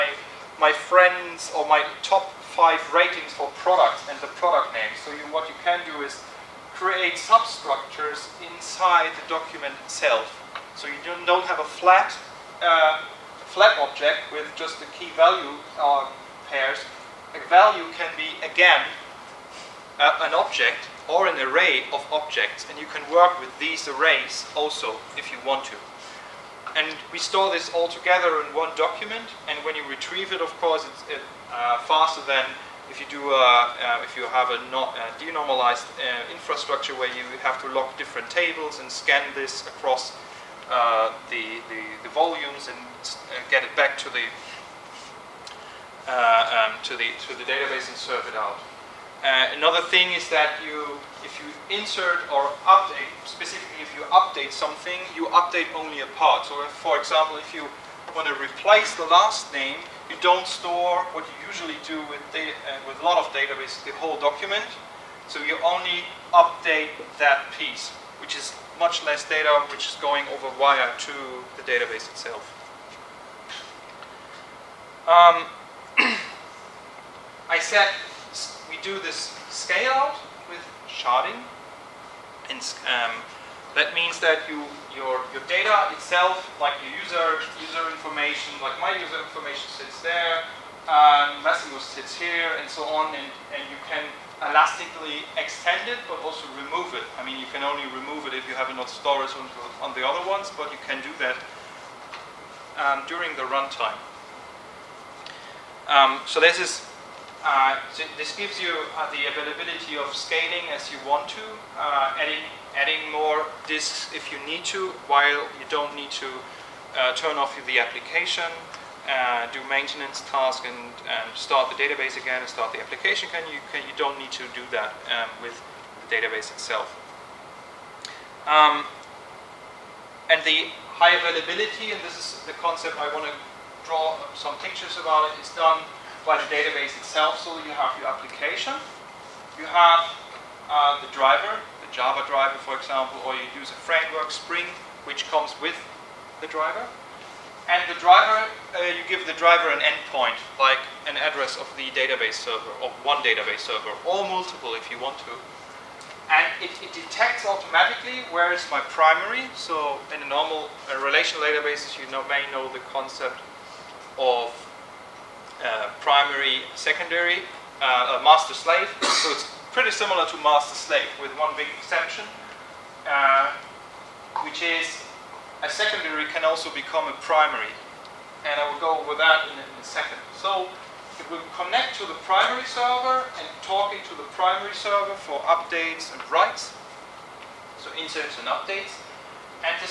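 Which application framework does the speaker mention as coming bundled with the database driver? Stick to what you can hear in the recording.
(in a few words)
Spring.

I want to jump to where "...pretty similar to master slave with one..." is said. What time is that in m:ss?
2:49.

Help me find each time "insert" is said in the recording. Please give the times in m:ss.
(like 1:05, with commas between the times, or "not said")
0:51, 3:08.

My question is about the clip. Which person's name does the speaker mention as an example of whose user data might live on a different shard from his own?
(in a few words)
Massimo.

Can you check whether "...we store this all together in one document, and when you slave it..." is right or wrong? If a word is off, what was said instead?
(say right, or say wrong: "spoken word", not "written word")
wrong: "retrieve", not "slave".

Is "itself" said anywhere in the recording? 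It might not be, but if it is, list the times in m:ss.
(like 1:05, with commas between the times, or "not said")
0:09, 1:12, 1:25, 2:06, 2:16.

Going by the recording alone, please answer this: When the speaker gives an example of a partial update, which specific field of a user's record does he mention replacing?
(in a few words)
last name.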